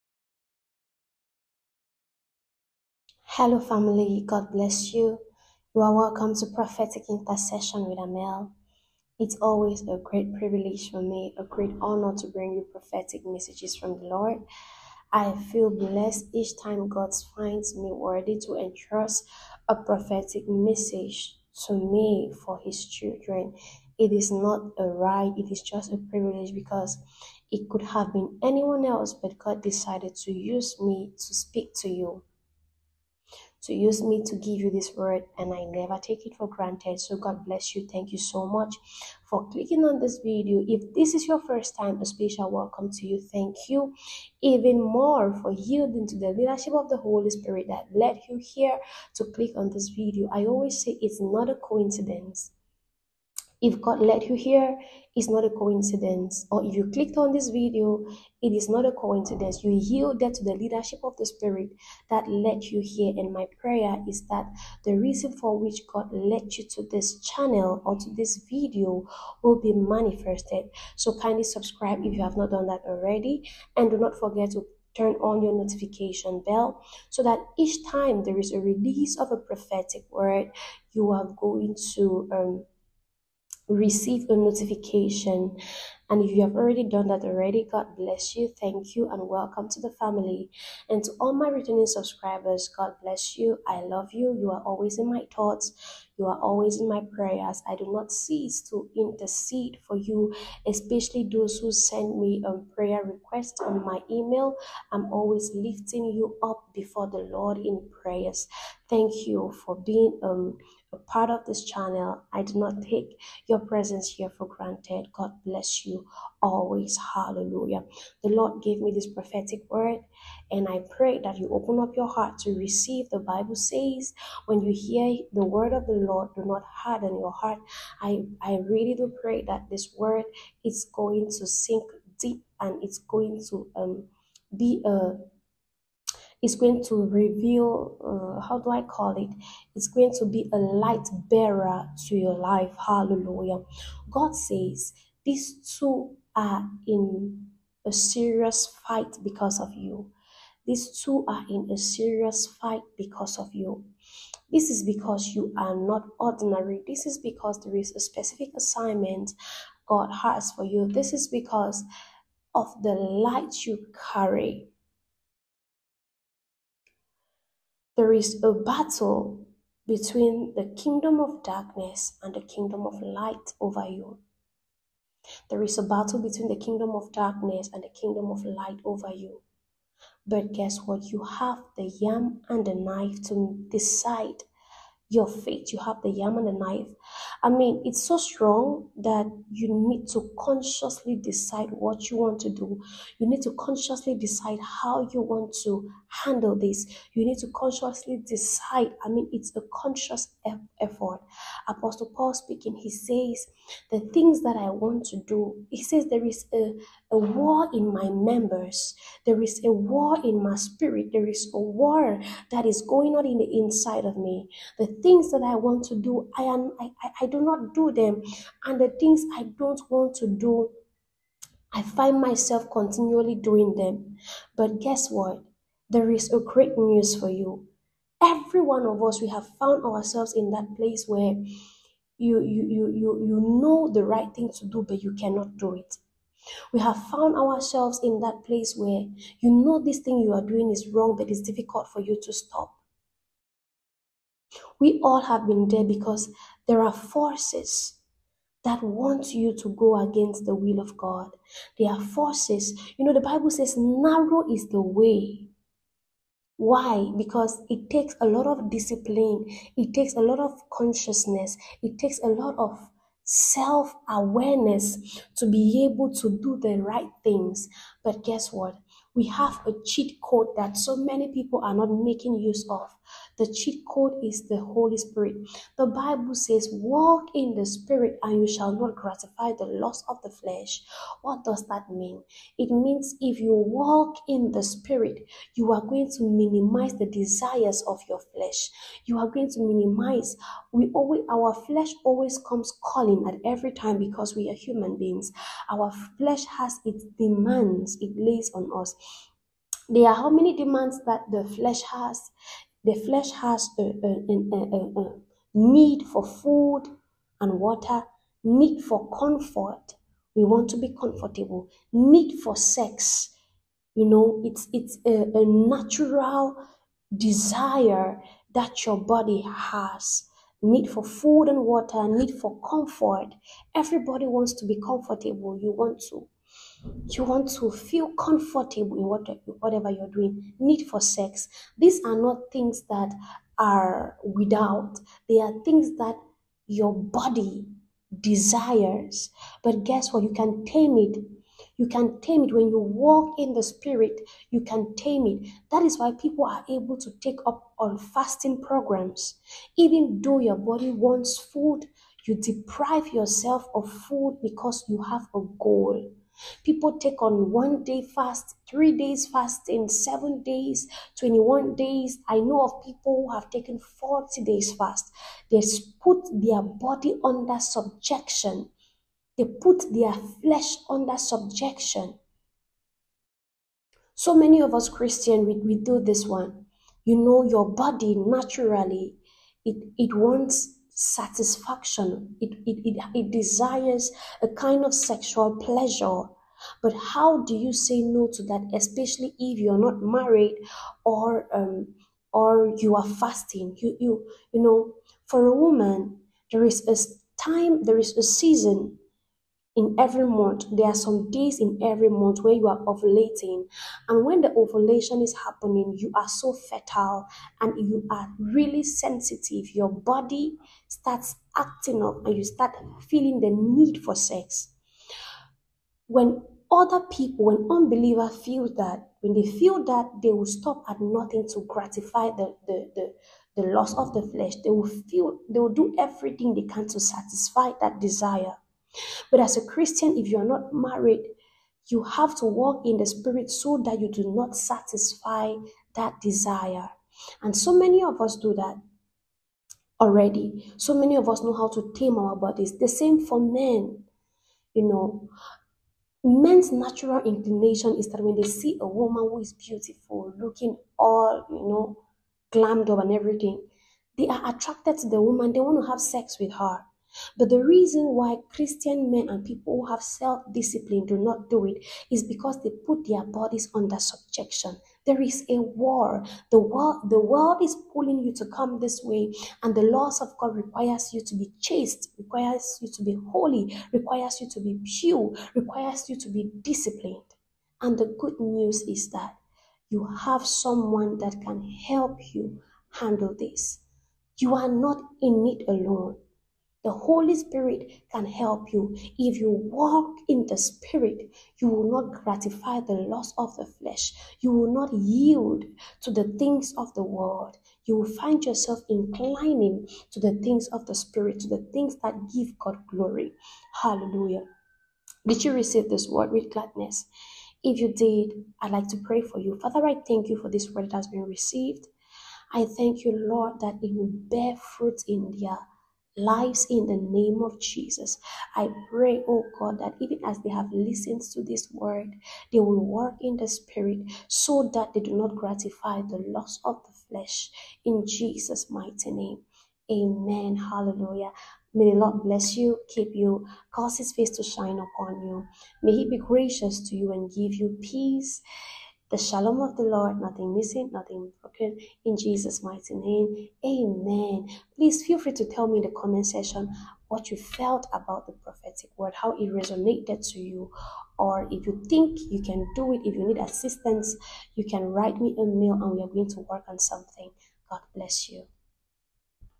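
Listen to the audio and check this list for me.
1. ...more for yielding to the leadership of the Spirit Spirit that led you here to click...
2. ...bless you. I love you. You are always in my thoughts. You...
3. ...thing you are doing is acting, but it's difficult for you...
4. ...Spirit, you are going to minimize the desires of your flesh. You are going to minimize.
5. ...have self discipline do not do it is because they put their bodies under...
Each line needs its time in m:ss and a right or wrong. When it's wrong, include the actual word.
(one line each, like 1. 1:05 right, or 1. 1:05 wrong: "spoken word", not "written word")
1. 0:44 wrong: "Holy", not "Spirit"
2. 1:33 right
3. 3:59 wrong: "wrong", not "acting"
4. 4:44 right
5. 7:39 right.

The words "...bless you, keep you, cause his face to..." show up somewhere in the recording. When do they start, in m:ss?
8:52.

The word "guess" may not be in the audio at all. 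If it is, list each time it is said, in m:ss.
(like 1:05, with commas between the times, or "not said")
3:00, 3:44, 4:28, 5:39.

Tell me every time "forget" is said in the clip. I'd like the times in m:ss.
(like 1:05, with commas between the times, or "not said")
1:14.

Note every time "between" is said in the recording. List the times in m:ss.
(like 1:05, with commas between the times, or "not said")
2:49, 2:56.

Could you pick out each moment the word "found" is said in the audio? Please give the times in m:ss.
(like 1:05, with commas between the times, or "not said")
3:49, 3:57.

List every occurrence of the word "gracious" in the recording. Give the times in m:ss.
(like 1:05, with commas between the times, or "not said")
8:56.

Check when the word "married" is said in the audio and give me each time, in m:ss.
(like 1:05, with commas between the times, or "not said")
6:30, 7:10.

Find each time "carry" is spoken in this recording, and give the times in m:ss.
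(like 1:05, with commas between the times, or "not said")
2:44.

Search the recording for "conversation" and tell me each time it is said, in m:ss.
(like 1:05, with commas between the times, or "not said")
not said.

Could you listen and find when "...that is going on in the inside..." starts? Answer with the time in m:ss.
3:32.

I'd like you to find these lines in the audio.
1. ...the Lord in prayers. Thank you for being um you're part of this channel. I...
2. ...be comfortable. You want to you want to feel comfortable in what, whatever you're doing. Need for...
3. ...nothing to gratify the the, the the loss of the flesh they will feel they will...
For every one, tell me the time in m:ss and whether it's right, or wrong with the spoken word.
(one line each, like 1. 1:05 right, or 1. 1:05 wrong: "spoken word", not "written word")
1. 1:47 right
2. 5:24 right
3. 7:00 right.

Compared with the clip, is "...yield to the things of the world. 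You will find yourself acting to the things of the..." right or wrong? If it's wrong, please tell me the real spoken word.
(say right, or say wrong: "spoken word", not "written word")
wrong: "inclining", not "acting".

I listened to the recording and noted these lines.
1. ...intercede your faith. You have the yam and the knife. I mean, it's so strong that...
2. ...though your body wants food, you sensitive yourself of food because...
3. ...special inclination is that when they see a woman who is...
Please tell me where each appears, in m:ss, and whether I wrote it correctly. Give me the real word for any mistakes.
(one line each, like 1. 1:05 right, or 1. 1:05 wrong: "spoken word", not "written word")
1. 3:03 wrong: "decide", not "intercede"
2. 5:50 wrong: "deprive", not "sensitive"
3. 7:26 wrong: "natural", not "special".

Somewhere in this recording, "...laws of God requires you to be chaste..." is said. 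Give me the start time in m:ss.
7:49.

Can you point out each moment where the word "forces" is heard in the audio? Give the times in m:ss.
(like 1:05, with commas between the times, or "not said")
4:06, 4:12.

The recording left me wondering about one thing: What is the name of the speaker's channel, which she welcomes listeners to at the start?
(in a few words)
Prophetic Intercession with Armelle.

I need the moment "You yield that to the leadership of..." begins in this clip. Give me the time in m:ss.
0:59.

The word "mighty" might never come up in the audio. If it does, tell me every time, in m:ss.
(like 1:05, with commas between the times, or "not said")
8:48, 9:02.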